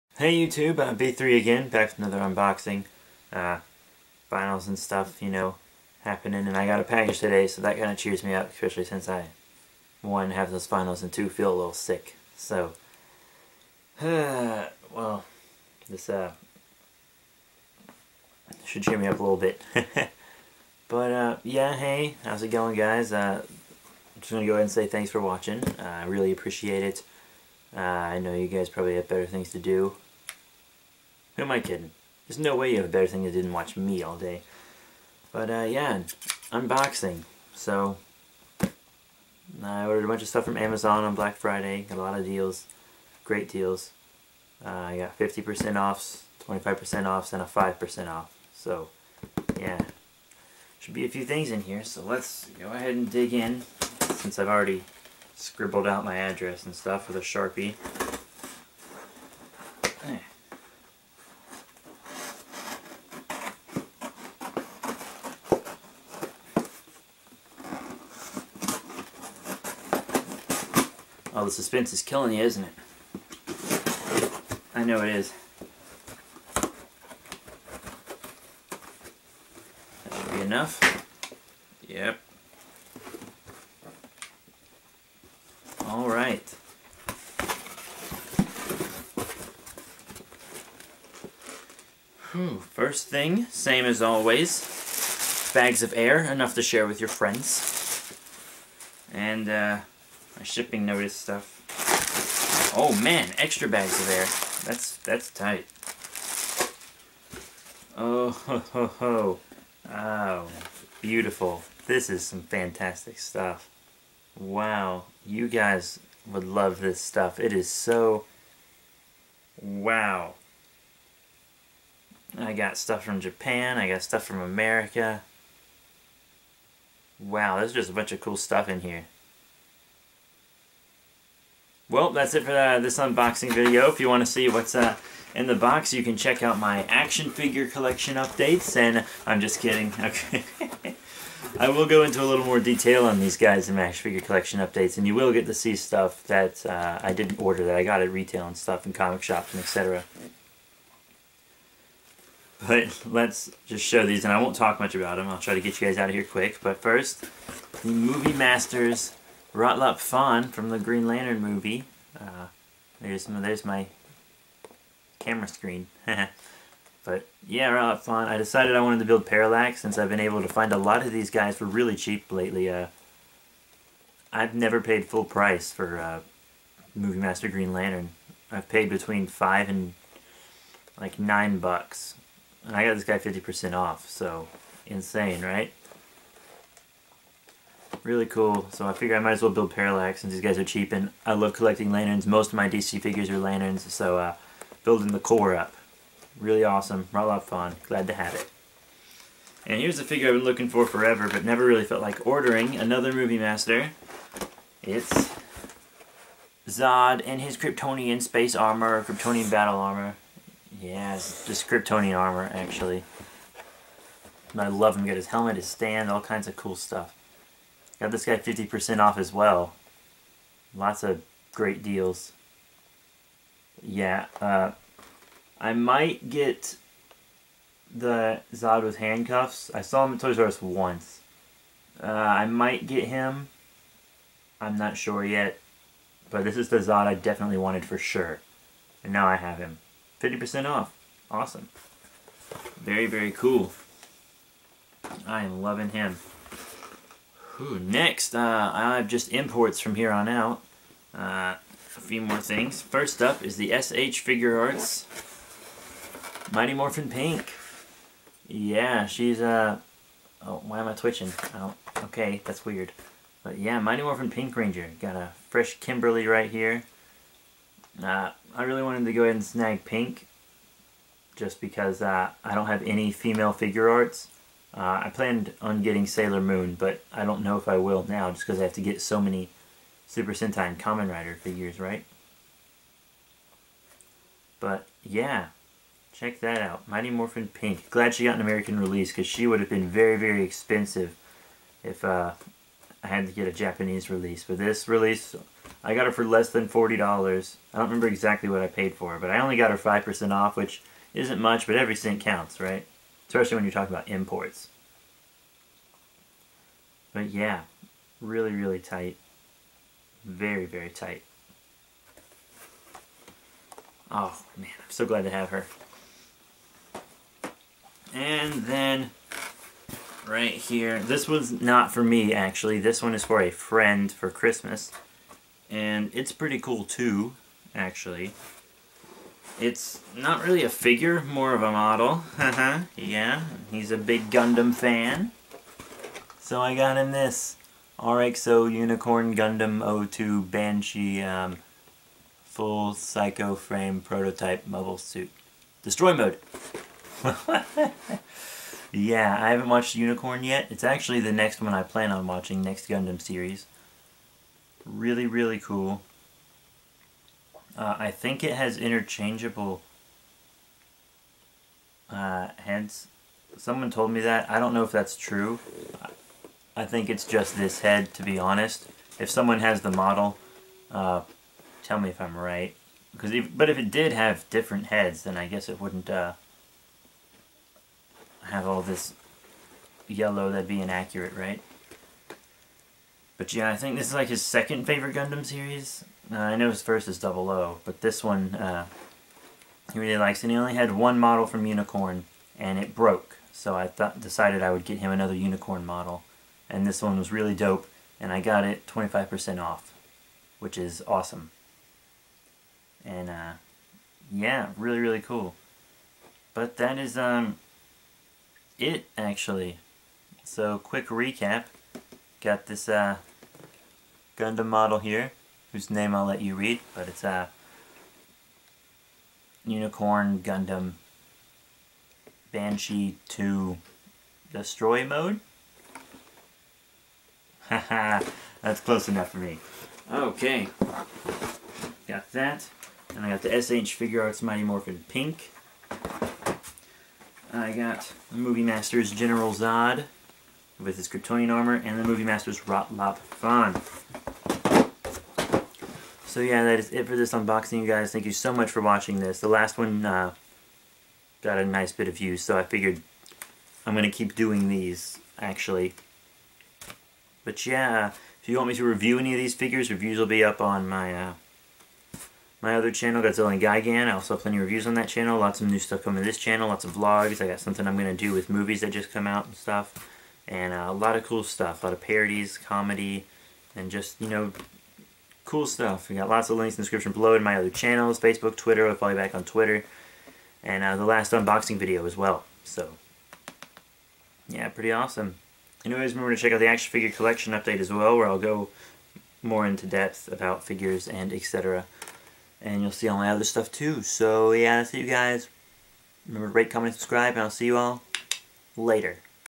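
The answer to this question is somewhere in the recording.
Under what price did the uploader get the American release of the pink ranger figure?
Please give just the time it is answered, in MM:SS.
04:56.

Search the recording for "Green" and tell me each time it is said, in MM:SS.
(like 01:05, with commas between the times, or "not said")
02:40, 02:57.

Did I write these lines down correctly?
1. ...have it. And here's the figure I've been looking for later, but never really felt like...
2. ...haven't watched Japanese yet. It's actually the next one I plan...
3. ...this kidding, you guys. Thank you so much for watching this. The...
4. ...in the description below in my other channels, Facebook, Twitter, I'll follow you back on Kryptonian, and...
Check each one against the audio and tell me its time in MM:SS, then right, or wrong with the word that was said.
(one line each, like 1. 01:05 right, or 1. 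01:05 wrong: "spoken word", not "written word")
1. 03:18 wrong: "forever", not "later"
2. 05:49 wrong: "Unicorn", not "Japanese"
3. 07:27 wrong: "unboxing", not "kidding"
4. 07:56 wrong: "Twitter", not "Kryptonian".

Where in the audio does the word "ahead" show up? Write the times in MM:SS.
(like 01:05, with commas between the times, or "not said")
00:24, 00:52, 04:29.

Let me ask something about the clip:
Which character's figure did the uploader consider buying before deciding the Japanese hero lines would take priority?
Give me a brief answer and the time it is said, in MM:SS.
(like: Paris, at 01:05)
Sailor Moon, at 04:36.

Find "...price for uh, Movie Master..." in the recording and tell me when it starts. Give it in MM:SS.
02:55.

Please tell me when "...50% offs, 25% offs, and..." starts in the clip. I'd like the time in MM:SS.
00:45.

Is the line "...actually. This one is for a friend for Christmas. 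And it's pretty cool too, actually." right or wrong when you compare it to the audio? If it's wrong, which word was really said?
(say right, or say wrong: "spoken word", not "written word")
right.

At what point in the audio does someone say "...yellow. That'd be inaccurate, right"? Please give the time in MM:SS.
06:20.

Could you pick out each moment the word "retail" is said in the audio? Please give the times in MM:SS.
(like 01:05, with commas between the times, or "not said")
02:28.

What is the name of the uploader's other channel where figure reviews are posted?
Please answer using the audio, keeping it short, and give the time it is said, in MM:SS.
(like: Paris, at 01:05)
Godzilla and Gigan, at 07:43.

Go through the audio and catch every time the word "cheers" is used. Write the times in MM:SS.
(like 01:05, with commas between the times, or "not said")
00:07, 00:18.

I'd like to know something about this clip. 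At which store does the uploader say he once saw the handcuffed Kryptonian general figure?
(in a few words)
Toys R Us.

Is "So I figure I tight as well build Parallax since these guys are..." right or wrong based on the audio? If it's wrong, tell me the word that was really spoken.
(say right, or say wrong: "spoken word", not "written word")
wrong: "might", not "tight".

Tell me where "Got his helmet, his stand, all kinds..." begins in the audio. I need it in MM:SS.
03:35.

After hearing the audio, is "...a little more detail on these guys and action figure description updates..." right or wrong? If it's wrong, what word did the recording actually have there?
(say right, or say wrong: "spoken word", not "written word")
wrong: "collection", not "description".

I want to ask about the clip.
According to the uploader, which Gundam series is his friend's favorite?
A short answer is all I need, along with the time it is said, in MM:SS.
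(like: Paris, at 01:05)
Double O, at 06:27.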